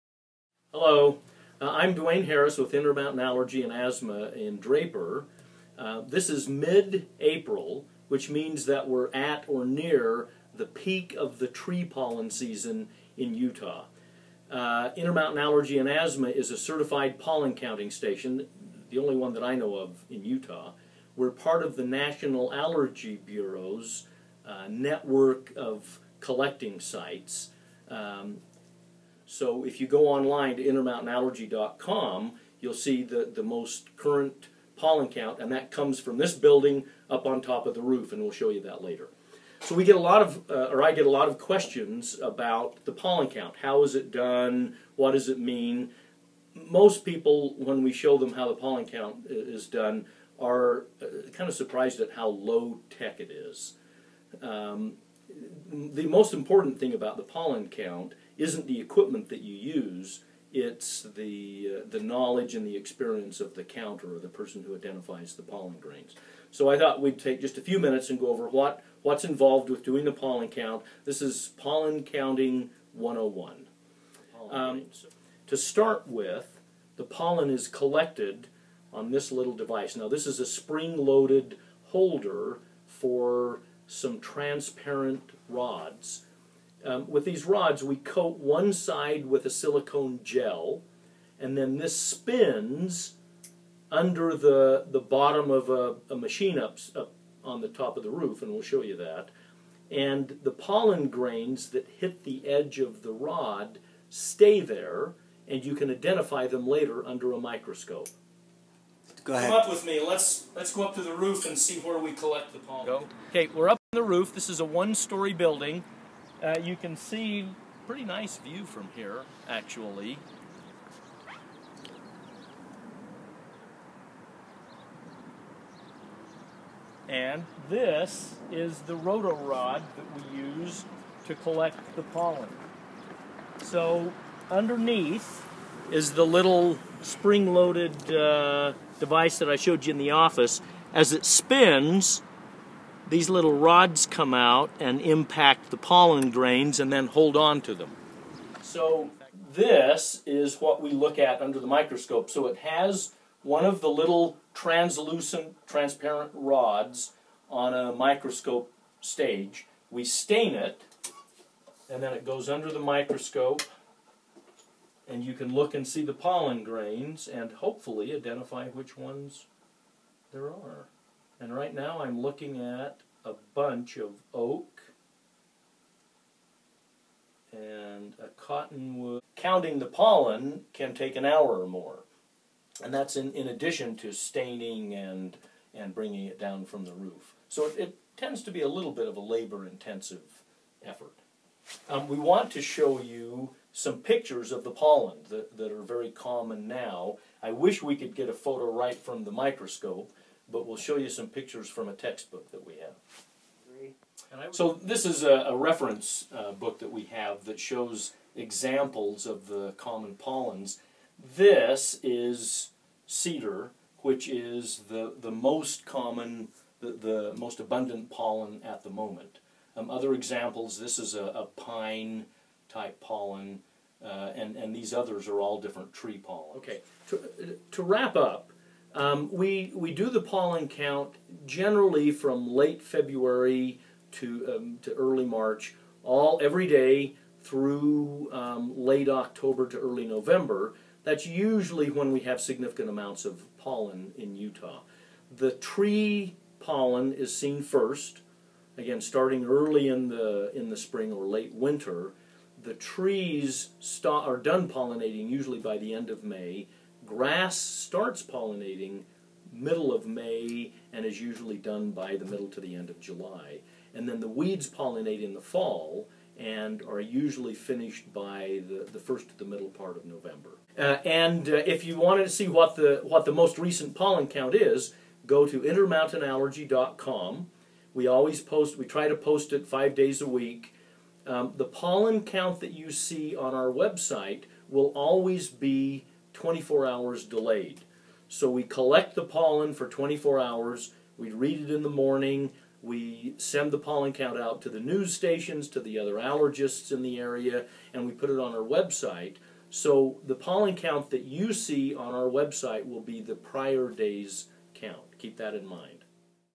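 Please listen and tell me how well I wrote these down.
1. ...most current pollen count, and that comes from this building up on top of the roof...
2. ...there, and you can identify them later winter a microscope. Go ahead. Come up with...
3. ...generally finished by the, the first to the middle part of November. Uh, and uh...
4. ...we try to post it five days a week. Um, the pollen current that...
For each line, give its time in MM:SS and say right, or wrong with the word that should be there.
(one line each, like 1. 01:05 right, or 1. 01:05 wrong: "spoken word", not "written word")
1. 00:33 right
2. 01:44 wrong: "under", not "winter"
3. 04:27 wrong: "usually", not "generally"
4. 04:38 wrong: "count", not "current".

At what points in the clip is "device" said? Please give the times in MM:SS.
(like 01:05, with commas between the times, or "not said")
01:19, 02:19.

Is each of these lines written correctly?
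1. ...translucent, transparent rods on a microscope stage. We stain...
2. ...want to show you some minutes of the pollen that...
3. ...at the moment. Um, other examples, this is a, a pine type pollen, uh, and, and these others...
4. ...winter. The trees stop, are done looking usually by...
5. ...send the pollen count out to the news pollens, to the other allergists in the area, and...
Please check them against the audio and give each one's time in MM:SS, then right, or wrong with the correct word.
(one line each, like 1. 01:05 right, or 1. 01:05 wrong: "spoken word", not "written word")
1. 02:34 right
2. 03:12 wrong: "pictures", not "minutes"
3. 03:38 right
4. 04:11 wrong: "pollinating", not "looking"
5. 04:53 wrong: "stations", not "pollens".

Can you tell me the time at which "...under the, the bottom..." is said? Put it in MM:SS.
01:33.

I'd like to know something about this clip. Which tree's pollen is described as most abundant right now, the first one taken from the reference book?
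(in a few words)
Cedar.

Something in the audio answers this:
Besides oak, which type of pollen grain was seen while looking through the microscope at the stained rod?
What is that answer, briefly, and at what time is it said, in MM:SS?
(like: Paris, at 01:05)
Cottonwood, at 02:58.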